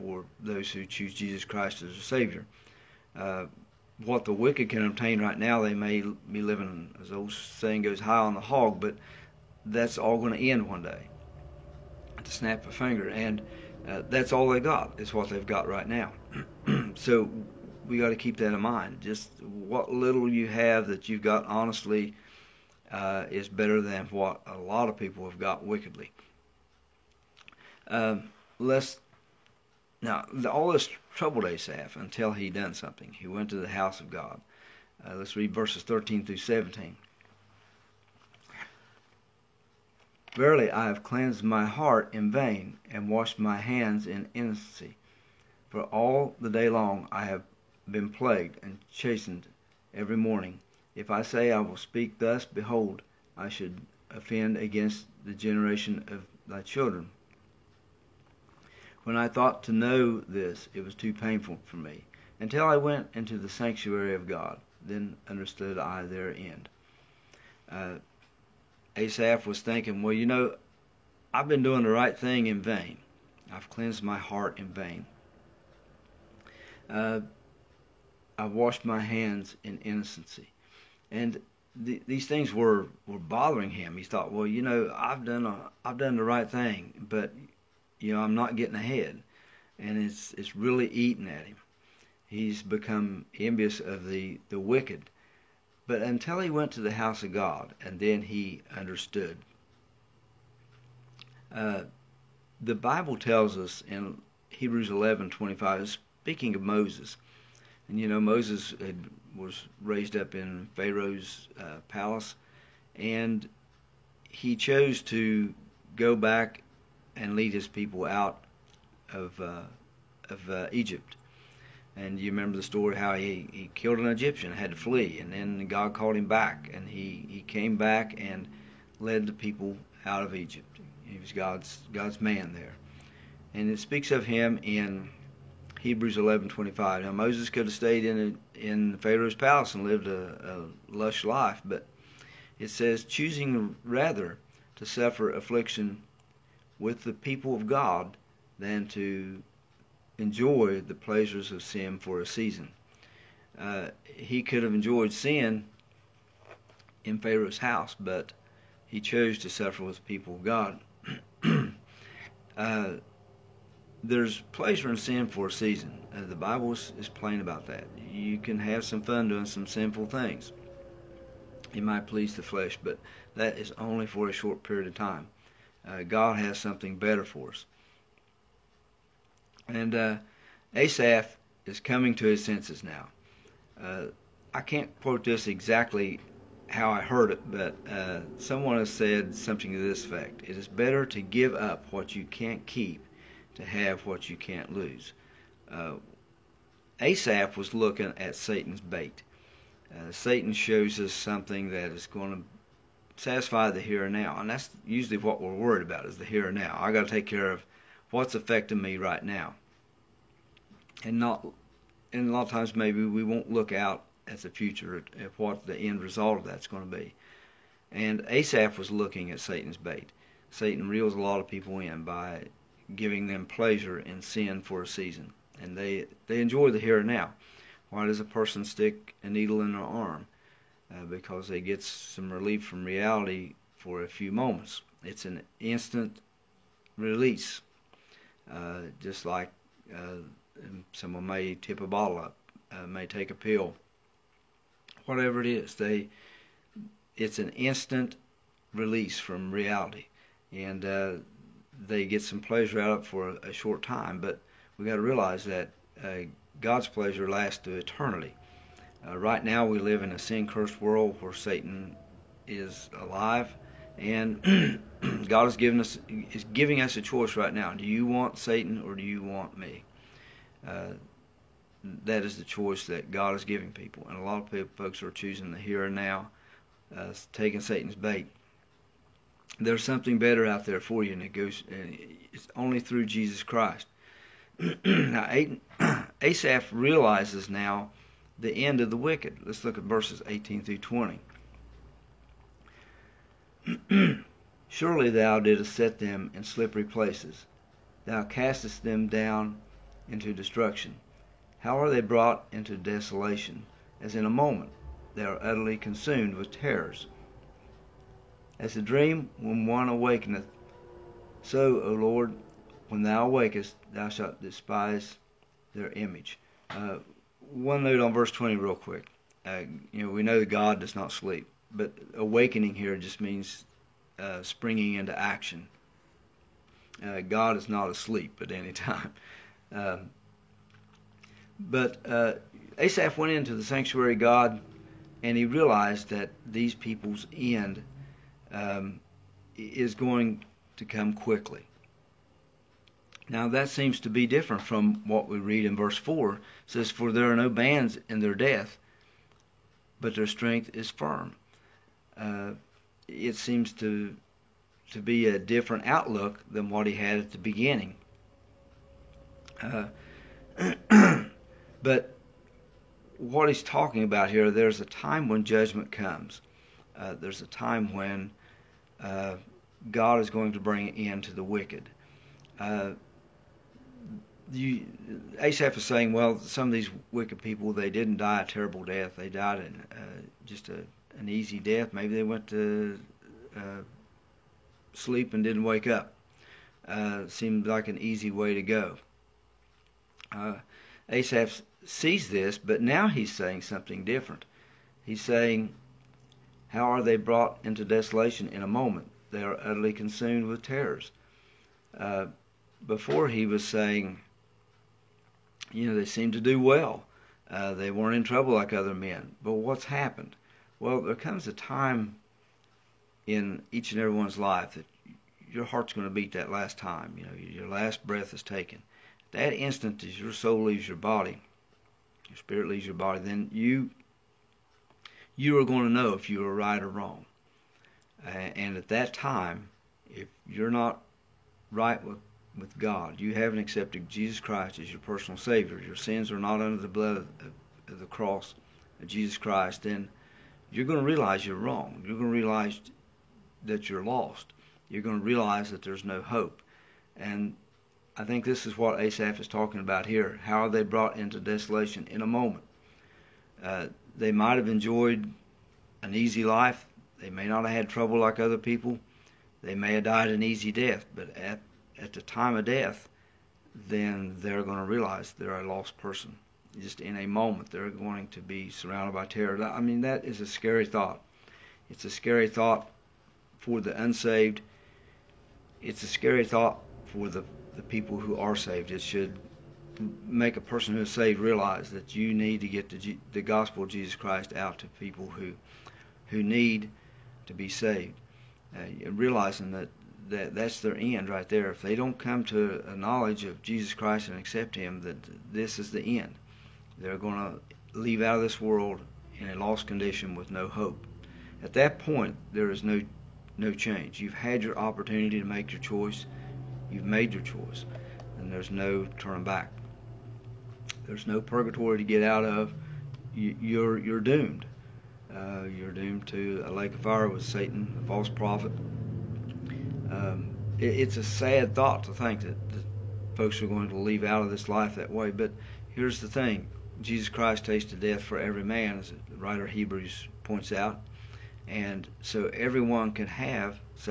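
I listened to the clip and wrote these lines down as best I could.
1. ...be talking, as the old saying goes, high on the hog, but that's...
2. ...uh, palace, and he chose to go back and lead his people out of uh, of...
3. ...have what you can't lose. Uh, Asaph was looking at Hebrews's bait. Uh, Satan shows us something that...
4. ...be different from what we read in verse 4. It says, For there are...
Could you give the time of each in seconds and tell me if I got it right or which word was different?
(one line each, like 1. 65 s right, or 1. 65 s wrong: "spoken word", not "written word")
1. 6 s wrong: "living", not "talking"
2. 111 s right
3. 193 s wrong: "Satan", not "Hebrews"
4. 344 s right.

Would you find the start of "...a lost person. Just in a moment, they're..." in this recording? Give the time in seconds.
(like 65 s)
465 s.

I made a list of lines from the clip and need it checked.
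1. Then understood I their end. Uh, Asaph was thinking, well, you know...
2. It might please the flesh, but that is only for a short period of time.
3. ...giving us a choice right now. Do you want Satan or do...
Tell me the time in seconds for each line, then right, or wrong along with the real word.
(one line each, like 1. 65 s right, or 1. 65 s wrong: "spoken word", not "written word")
1. 64 s right
2. 171 s right
3. 266 s right.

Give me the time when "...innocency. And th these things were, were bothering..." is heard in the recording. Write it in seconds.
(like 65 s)
79 s.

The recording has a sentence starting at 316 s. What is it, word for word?
Uh, one note on verse 20, real quick.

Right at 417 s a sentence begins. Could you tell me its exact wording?
You know, your last breath is taken.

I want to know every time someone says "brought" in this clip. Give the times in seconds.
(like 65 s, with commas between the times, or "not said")
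302 s, 397 s, 450 s.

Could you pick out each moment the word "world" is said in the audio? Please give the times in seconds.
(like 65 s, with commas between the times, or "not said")
260 s, 498 s.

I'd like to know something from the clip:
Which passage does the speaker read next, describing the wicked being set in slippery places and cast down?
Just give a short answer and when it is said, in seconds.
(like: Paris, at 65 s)
18 through 20, at 290 s.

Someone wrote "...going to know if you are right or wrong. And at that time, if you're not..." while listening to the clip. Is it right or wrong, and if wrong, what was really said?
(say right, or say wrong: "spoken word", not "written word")
right.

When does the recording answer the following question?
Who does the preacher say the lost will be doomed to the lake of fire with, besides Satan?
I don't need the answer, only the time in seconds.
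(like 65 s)
518 s.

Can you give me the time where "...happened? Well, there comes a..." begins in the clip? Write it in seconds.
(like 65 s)
409 s.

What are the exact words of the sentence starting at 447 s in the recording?
And I think this is what Asaph is talking about here.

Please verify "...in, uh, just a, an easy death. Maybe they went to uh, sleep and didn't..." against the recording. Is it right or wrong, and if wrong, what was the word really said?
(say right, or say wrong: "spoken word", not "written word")
right.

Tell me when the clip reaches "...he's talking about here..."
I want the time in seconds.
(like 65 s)
363 s.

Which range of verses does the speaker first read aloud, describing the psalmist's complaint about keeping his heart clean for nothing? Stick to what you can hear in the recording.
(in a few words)
13 through 17.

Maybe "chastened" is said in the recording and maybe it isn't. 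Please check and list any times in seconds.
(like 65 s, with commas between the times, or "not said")
48 s.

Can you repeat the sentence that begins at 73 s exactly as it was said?
I've cleansed my heart in vain.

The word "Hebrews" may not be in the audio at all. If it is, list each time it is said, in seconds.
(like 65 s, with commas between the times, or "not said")
104 s, 135 s, 529 s.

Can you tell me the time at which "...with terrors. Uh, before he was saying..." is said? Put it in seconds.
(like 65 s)
400 s.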